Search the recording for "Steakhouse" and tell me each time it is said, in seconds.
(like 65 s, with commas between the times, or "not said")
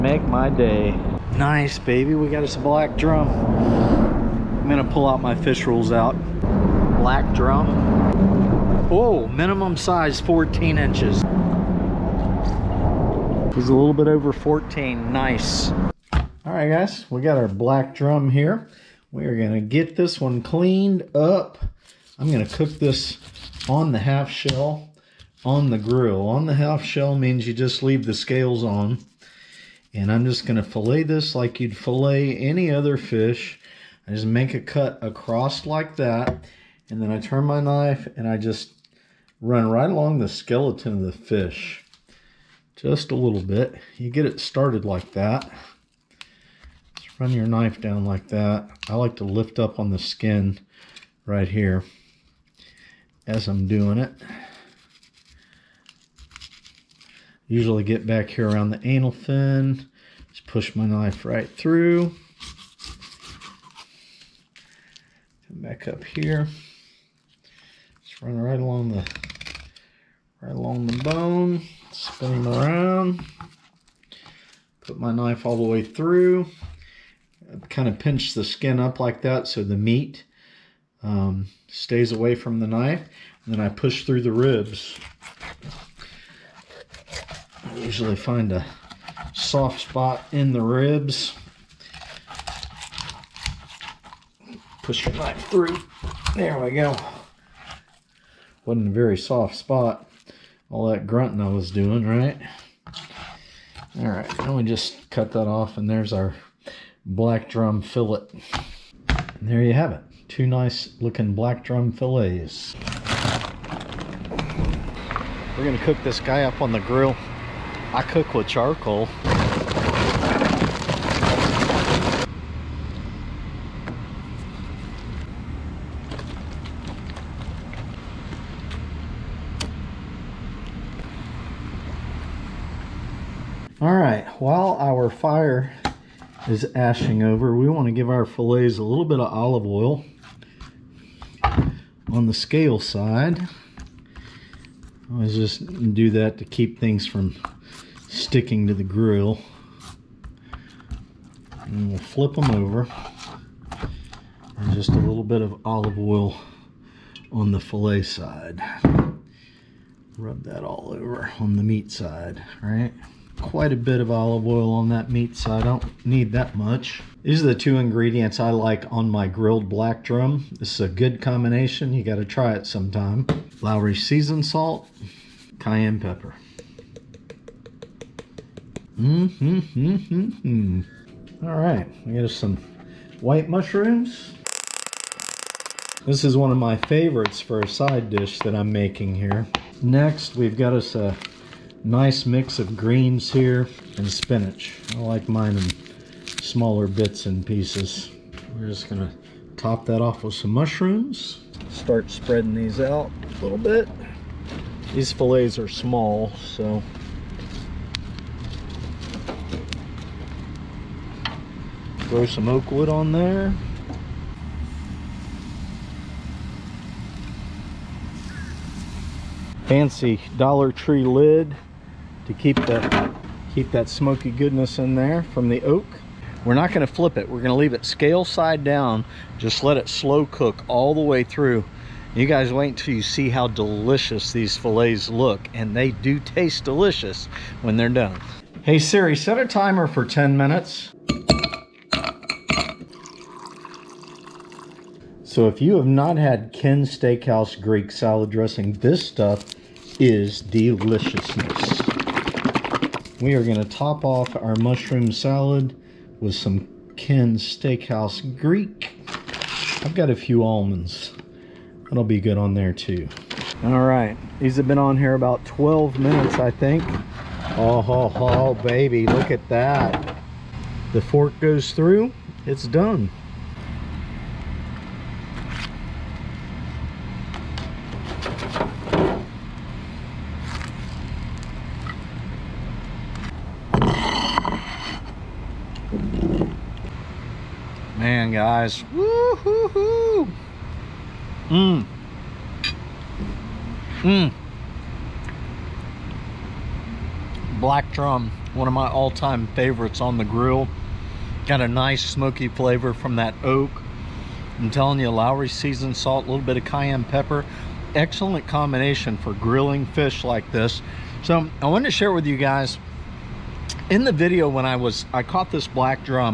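246 s, 257 s.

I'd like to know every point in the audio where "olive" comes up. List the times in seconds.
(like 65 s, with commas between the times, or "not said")
139 s, 155 s, 164 s.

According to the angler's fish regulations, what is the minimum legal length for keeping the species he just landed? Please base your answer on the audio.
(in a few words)
14 inches.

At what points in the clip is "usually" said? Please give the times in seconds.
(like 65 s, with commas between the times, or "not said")
57 s, 87 s.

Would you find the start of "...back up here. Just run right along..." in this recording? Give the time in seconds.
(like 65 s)
65 s.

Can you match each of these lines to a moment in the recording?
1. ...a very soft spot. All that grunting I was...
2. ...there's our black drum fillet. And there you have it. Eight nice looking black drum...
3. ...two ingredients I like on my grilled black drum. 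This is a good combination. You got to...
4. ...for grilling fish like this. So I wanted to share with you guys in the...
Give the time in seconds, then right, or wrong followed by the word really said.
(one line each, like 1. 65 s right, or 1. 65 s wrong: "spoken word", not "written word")
1. 98 s right
2. 105 s wrong: "Two", not "Eight"
3. 167 s right
4. 309 s right.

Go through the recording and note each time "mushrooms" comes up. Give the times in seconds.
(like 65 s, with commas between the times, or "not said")
183 s, 200 s, 254 s.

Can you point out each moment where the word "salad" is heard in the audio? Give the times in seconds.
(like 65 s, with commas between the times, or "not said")
247 s, 255 s.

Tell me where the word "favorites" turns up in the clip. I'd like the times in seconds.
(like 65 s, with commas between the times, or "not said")
186 s, 299 s.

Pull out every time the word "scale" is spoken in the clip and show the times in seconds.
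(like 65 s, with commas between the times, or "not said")
28 s, 142 s, 227 s.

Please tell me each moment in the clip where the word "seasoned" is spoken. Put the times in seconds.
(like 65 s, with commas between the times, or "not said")
174 s, 305 s.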